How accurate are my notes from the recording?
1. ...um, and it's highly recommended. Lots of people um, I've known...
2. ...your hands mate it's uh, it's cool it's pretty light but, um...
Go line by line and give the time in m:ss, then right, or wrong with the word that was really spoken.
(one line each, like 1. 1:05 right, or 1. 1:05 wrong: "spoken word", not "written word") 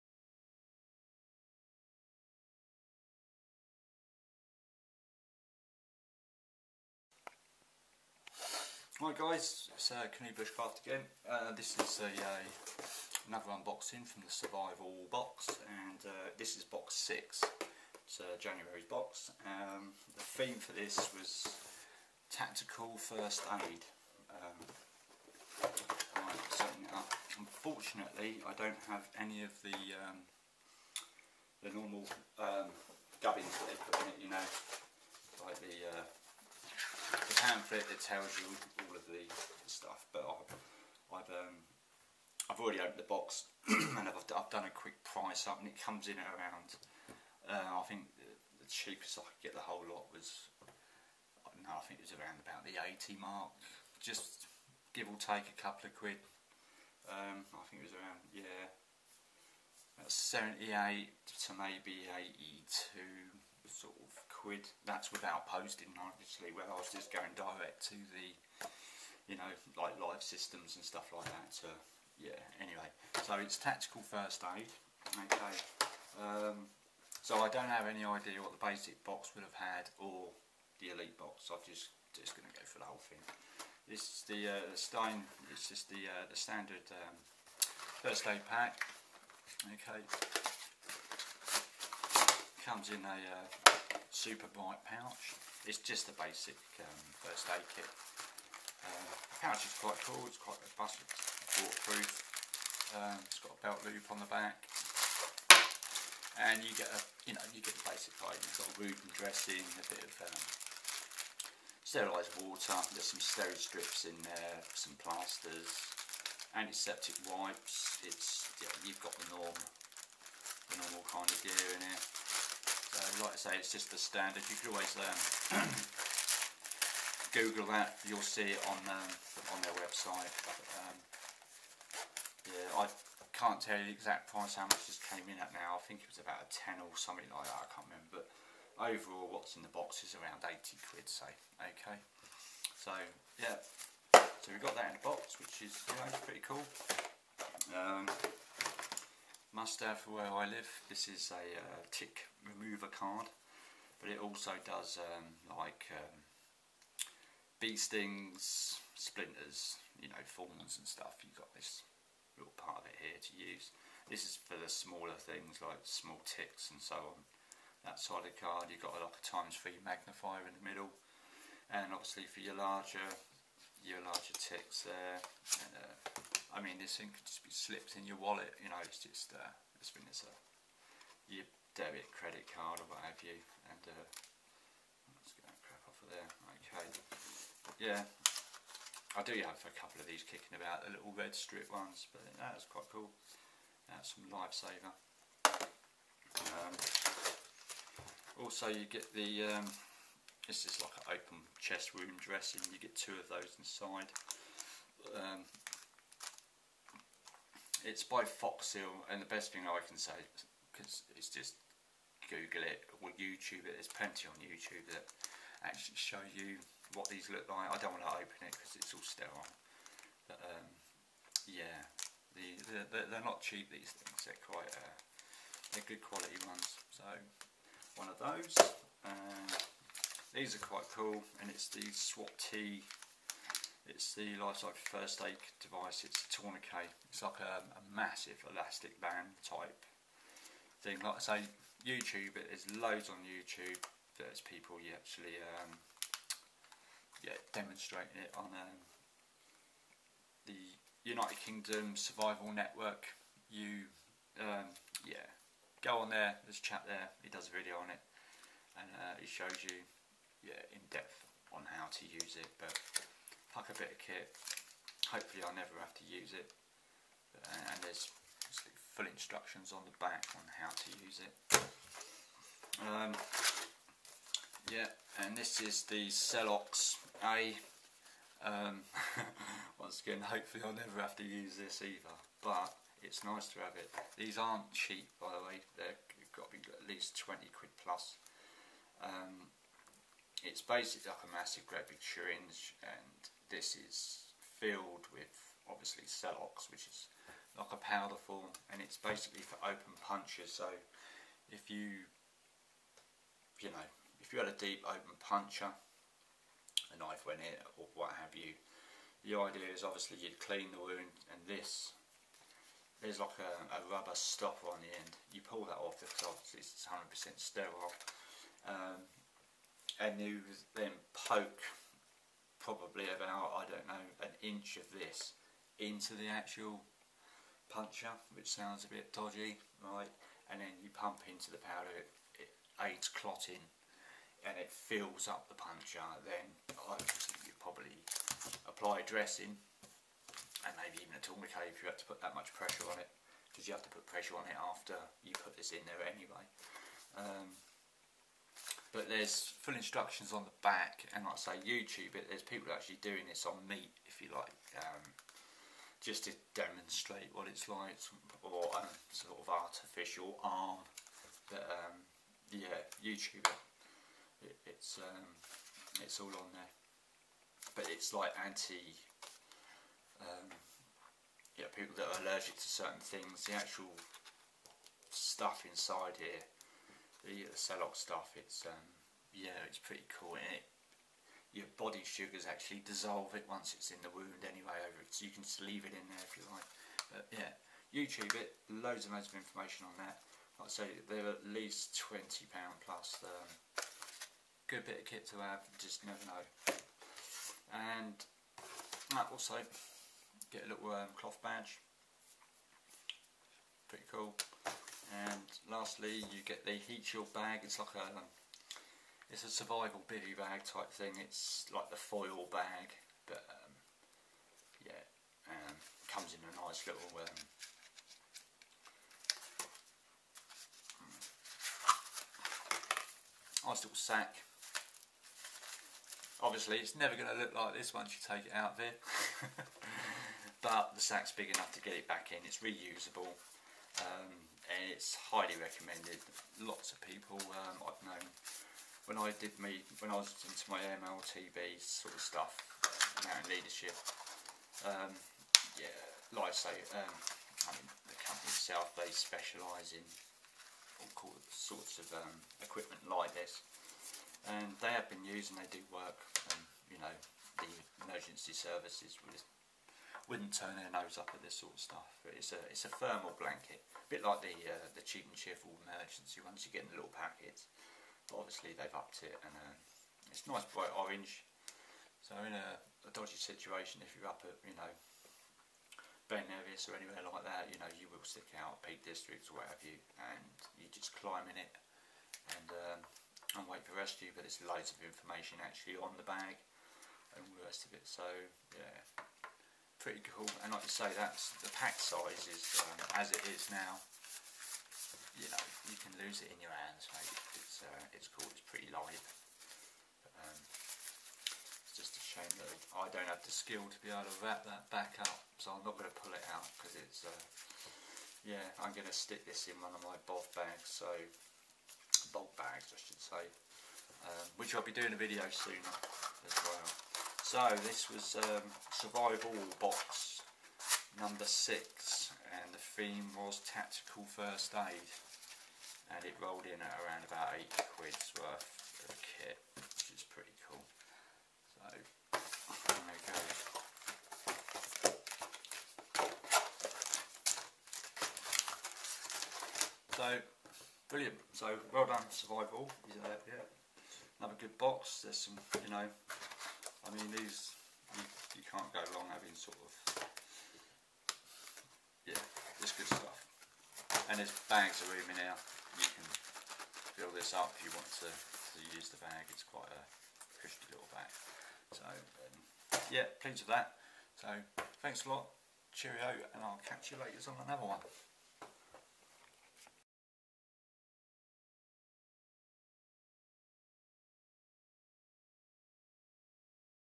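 1. 7:13 right
2. 8:16 right.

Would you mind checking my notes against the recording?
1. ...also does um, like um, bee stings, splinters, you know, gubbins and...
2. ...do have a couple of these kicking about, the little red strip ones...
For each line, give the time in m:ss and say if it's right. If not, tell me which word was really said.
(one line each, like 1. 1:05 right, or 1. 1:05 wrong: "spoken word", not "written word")
1. 2:34 wrong: "thorns", not "gubbins"
2. 3:09 right.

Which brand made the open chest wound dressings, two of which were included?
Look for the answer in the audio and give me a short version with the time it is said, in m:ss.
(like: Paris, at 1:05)
Foxseal, at 3:28.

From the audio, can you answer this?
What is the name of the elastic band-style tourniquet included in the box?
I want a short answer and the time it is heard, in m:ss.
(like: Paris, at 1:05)
SWAT T, at 3:51.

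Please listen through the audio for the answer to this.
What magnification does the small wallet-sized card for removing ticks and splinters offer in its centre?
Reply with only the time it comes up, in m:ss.
2:49.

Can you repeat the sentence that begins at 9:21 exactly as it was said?
So um, yeah, pleased with that.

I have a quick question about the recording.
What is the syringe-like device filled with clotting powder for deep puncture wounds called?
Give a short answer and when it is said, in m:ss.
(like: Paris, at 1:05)
Celox A, at 4:36.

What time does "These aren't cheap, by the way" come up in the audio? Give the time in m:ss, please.
4:44.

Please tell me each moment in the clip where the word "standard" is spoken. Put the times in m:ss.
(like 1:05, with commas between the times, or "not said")
1:26, 2:03.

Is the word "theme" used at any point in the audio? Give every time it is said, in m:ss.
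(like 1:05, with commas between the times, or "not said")
0:20, 8:42.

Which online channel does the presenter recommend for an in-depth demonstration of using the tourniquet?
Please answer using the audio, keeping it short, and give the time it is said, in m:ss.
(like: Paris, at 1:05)
United Kingdom Survival Network, at 4:11.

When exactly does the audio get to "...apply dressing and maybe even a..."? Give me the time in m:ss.
5:38.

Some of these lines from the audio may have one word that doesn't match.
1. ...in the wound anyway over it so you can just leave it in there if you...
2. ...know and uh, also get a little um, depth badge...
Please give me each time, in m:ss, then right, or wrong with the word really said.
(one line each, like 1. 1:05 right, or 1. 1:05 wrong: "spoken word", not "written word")
1. 6:23 right
2. 6:36 wrong: "cloth", not "depth".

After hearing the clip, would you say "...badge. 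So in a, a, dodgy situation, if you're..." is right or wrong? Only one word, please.
wrong.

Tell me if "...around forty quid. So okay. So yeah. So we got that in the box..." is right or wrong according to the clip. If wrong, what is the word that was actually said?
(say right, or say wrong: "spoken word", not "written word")
wrong: "eighty", not "forty".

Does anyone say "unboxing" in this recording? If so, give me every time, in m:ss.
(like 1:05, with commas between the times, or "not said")
0:13.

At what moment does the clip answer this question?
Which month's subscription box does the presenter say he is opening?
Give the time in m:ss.
0:18.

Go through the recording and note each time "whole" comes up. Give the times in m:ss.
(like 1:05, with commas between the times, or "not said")
0:49, 1:22.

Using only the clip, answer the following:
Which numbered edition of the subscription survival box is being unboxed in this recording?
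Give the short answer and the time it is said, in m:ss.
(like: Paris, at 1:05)
6, at 0:16.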